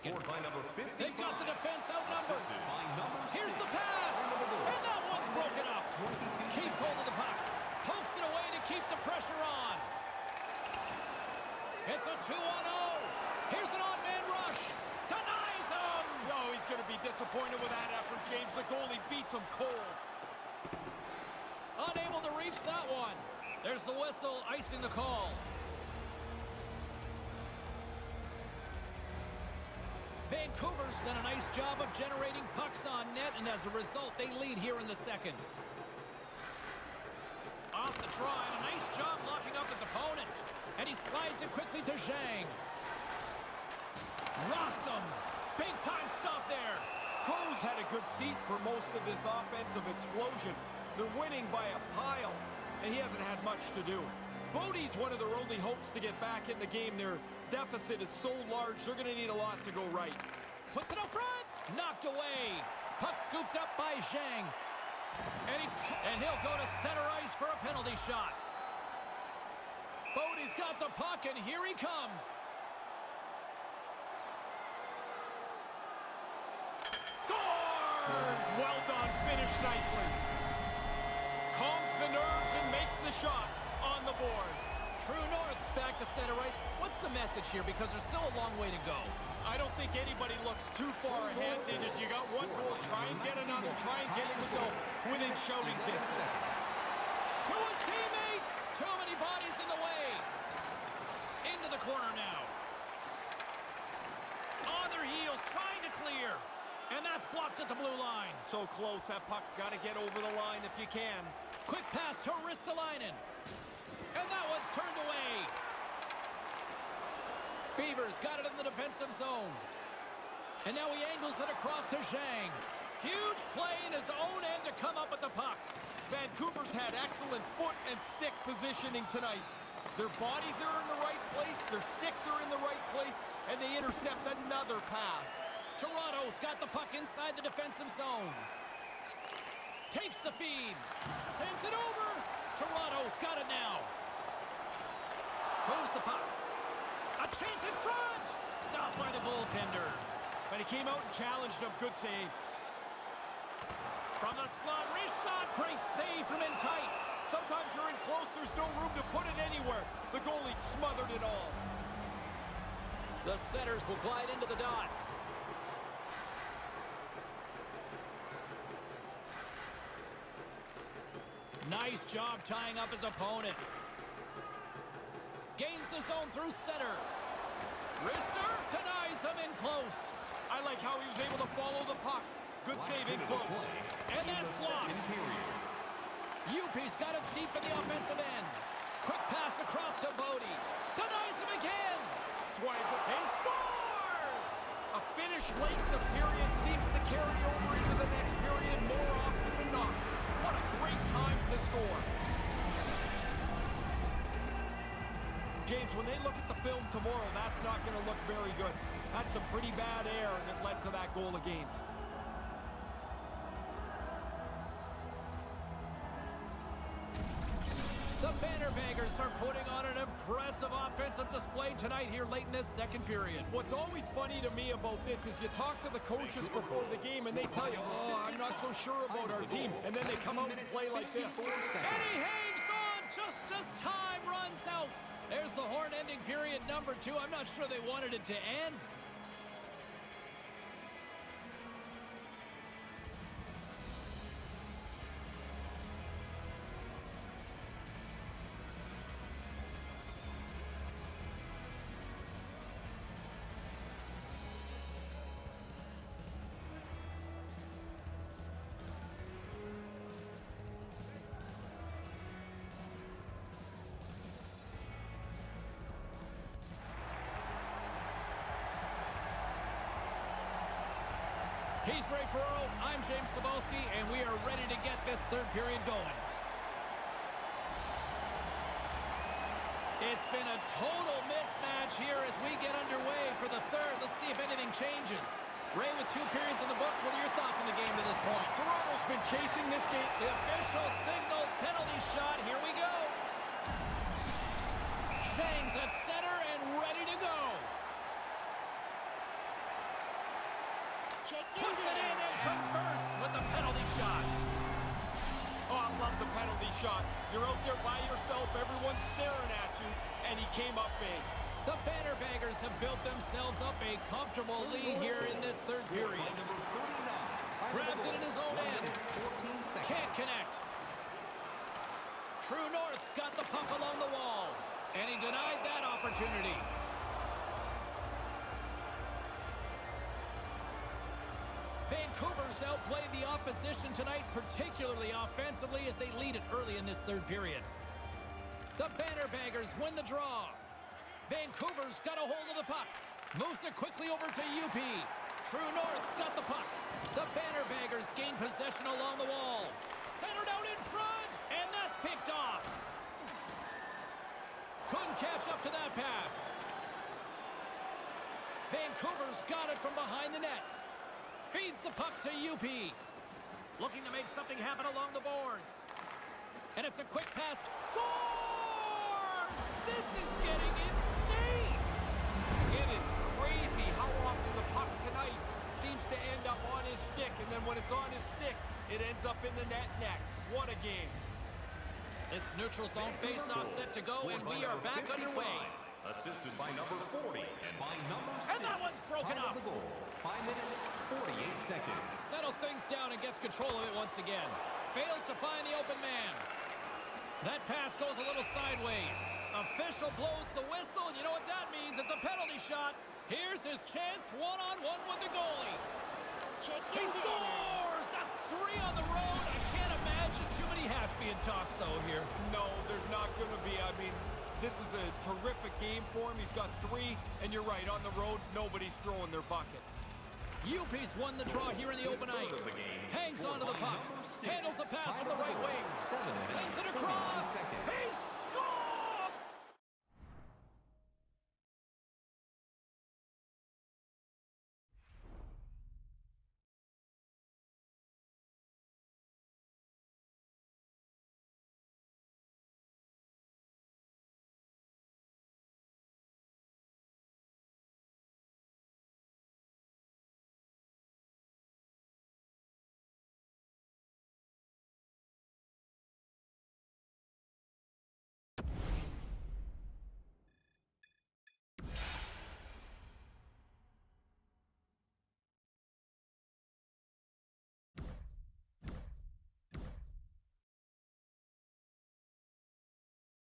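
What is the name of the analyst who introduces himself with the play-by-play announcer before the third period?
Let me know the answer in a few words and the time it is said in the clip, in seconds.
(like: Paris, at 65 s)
Ray Ferraro, at 272 s.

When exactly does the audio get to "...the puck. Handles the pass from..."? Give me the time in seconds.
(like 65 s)
423 s.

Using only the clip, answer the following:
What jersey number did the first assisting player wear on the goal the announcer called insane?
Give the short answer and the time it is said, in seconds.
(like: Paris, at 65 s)
40, at 386 s.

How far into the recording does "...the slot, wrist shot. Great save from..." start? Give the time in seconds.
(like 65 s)
154 s.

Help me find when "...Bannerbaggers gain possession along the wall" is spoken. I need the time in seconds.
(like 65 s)
347 s.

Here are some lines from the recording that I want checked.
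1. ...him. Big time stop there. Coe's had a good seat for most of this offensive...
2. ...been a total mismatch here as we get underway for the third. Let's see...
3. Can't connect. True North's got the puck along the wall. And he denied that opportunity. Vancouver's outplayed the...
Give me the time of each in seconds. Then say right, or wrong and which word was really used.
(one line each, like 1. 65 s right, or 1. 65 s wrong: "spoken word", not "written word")
1. 44 s right
2. 280 s right
3. 319 s right.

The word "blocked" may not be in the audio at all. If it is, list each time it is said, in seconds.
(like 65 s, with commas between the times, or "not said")
107 s, 184 s.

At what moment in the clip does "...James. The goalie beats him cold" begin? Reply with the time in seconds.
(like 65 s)
18 s.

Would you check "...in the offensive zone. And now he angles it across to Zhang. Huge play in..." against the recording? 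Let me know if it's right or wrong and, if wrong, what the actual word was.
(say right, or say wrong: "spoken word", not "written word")
wrong: "defensive", not "offensive".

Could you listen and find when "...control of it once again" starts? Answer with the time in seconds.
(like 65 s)
393 s.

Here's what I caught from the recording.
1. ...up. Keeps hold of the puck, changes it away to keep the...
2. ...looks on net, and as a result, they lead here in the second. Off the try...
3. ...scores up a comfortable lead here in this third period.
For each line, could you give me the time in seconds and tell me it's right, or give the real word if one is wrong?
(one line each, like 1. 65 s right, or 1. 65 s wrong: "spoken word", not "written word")
1. 5 s wrong: "pokes", not "changes"
2. 32 s wrong: "pucks", not "looks"
3. 313 s wrong: "themselves", not "scores".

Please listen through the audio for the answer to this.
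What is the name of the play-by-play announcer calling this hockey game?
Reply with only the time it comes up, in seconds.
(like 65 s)
273 s.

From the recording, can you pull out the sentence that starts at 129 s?
Their bodies are in the right place, their sticks are in the right place, and they intercept another pass.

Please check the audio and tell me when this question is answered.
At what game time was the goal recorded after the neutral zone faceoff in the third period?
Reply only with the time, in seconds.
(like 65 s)
390 s.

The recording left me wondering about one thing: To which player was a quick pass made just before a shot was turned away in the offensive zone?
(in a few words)
Ristolainen.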